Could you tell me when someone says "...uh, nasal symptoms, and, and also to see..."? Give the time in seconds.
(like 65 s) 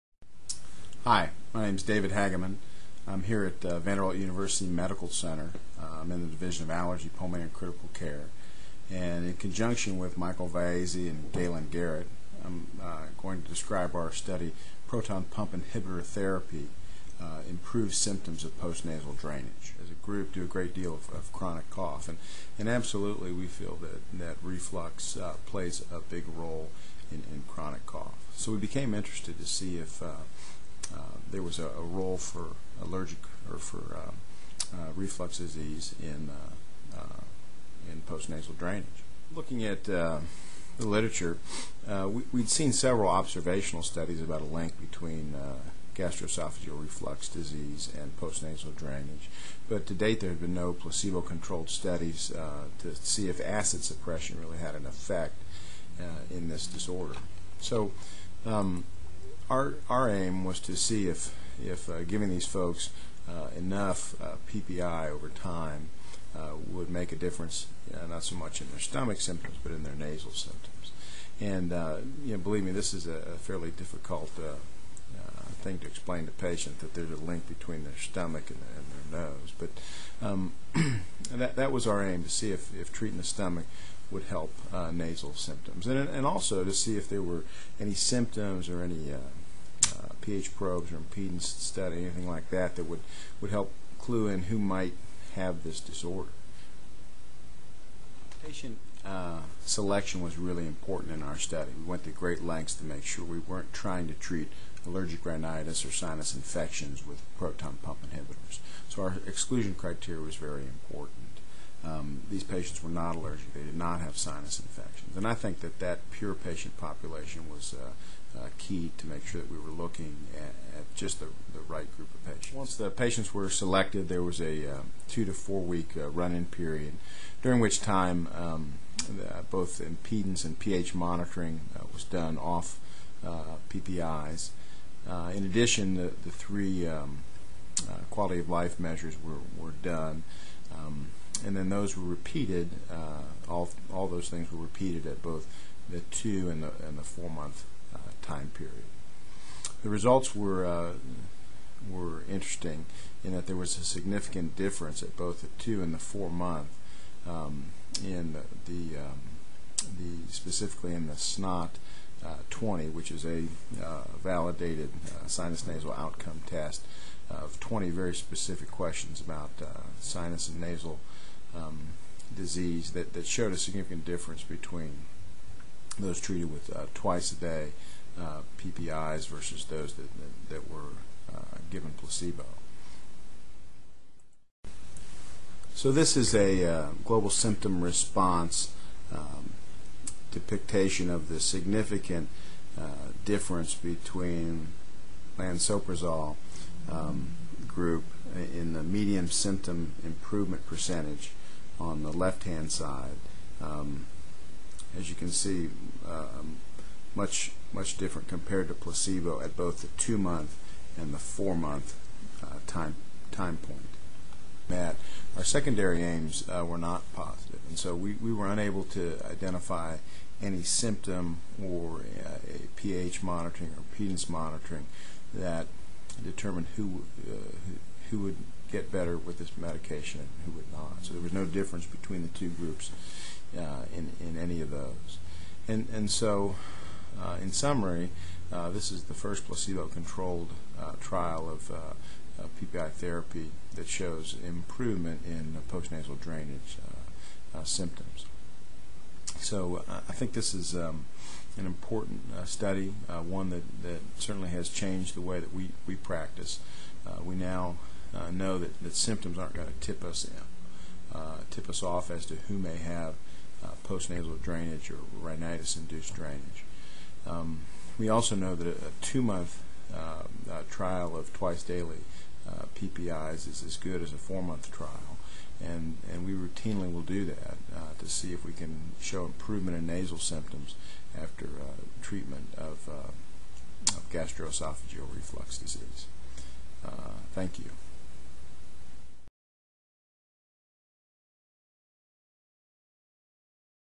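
84 s.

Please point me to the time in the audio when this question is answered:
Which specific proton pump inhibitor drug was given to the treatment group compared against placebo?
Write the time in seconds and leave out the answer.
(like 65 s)
195 s.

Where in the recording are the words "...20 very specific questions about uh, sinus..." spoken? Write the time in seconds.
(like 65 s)
167 s.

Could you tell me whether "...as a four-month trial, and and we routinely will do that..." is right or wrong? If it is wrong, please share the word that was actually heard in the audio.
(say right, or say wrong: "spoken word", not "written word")
right.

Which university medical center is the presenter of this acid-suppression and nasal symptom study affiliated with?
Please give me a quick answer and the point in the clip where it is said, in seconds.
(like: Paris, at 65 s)
Vanderbilt, at 3 s.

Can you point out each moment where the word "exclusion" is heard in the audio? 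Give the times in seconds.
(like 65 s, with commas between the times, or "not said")
109 s.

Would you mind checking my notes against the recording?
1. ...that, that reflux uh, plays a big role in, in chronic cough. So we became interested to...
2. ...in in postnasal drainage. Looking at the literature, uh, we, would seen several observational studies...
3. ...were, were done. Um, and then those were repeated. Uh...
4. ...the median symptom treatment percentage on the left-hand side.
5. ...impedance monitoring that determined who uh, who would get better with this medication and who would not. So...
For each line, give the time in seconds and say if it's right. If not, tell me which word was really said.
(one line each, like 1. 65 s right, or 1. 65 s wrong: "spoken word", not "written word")
1. 23 s right
2. 36 s right
3. 139 s right
4. 198 s wrong: "improvement", not "treatment"
5. 223 s right.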